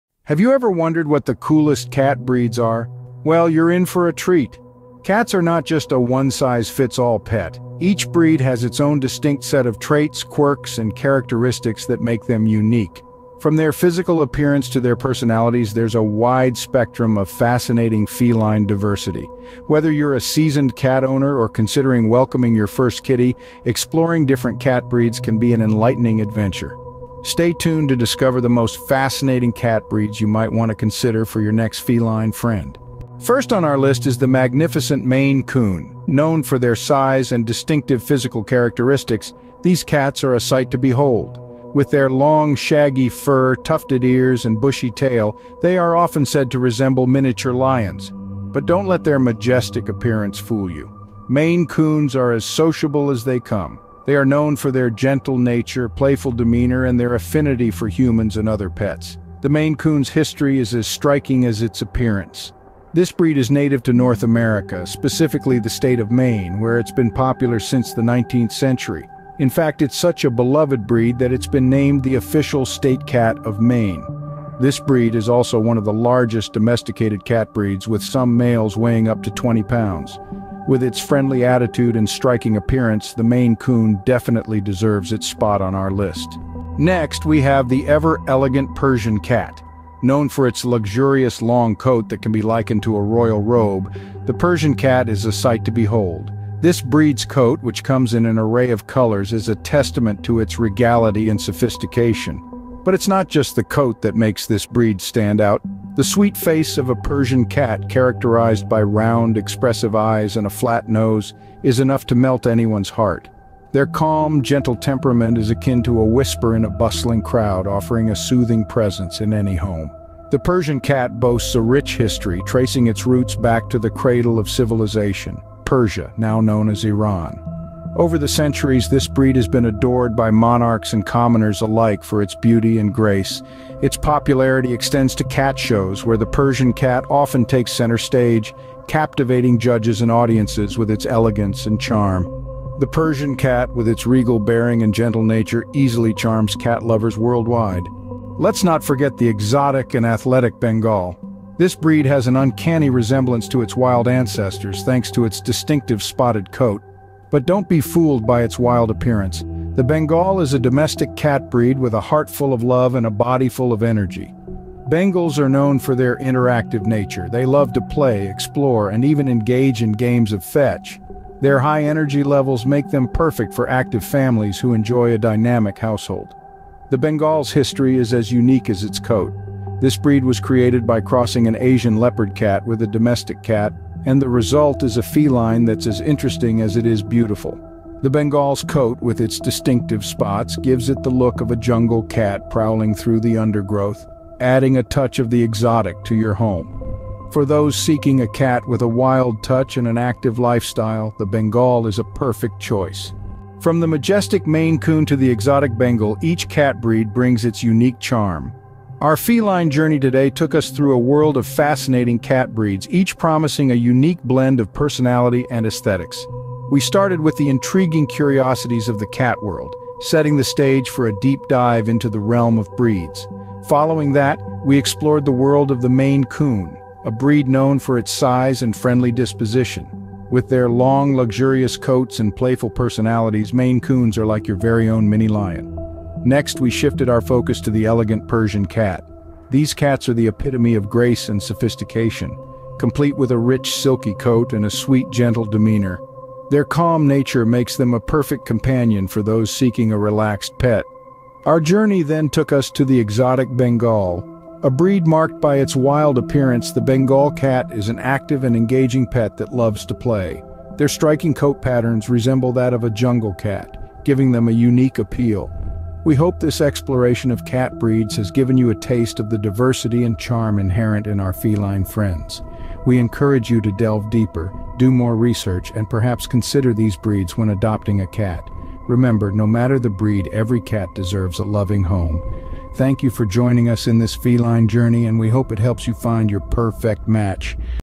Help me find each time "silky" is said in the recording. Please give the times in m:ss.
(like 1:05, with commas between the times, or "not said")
4:03.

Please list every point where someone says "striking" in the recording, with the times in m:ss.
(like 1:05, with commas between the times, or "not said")
1:00, 1:22, 4:20.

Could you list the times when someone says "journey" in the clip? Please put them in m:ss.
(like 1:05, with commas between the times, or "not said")
3:29, 4:11, 4:44.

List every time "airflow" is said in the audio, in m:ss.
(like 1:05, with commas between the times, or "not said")
not said.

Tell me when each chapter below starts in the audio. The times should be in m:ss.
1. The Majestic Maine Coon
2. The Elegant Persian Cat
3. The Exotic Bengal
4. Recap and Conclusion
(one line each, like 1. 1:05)
1. 0:33
2. 1:26
3. 2:28
4. 3:23.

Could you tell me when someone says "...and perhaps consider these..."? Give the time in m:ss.
4:35.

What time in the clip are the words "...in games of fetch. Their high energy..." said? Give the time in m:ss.
2:49.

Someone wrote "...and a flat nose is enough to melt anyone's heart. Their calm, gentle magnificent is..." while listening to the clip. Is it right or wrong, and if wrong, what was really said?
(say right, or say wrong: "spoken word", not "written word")
wrong: "temperament", not "magnificent".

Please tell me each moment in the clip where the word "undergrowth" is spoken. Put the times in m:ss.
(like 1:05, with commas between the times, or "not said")
3:13.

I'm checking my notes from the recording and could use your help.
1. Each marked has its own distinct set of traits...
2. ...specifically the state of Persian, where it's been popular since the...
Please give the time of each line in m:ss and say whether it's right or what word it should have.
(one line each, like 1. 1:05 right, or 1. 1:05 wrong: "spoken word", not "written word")
1. 0:07 wrong: "breed", not "marked"
2. 1:04 wrong: "Maine", not "Persian".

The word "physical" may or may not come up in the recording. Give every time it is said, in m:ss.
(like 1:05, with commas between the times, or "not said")
0:13, 0:38.